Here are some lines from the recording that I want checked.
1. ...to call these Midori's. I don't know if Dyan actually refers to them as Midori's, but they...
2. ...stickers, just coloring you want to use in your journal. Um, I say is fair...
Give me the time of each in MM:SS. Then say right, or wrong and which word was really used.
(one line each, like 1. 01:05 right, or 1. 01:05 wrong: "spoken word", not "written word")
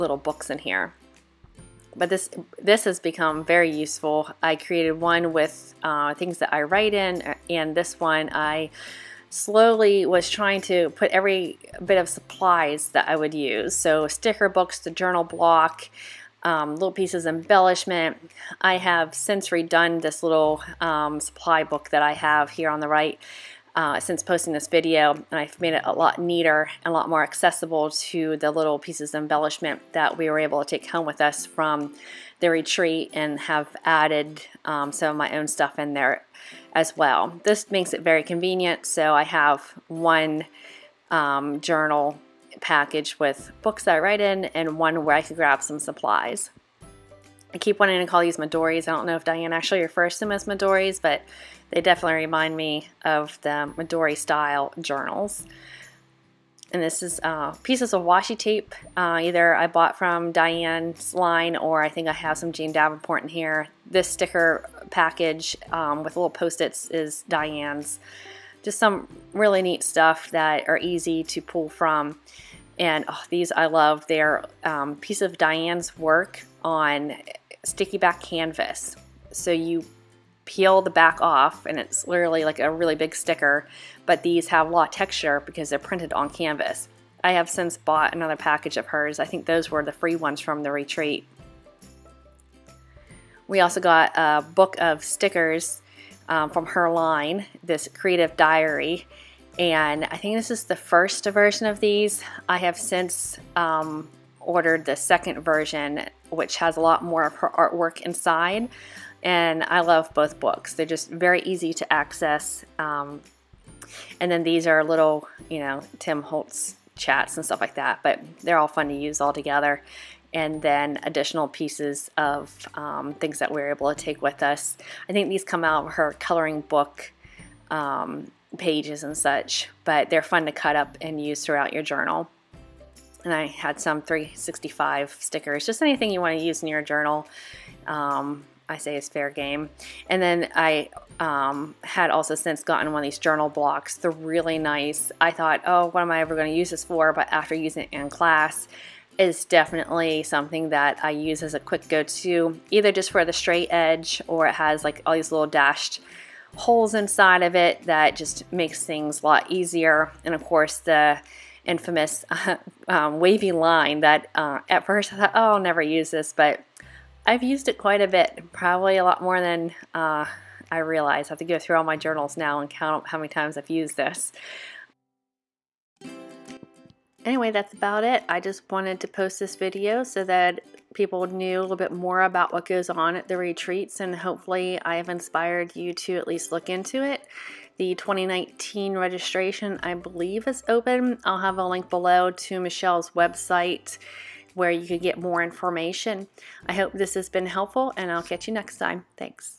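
1. 00:48 right
2. 02:15 wrong: "anything", not "coloring".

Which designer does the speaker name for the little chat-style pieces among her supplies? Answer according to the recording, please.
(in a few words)
Tim Holtz.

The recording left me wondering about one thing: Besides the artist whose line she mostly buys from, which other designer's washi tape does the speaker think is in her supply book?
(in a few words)
Jane Davenport.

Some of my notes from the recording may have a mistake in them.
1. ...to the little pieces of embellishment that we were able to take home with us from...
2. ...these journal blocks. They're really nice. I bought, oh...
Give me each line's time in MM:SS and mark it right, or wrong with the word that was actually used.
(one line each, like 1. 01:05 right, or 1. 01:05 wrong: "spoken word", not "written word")
1. 00:27 right
2. 02:23 wrong: "thought", not "bought".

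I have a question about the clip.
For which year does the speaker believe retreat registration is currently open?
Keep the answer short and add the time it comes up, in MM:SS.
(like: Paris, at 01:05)
2019, at 03:07.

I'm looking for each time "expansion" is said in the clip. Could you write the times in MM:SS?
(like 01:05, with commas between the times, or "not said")
not said.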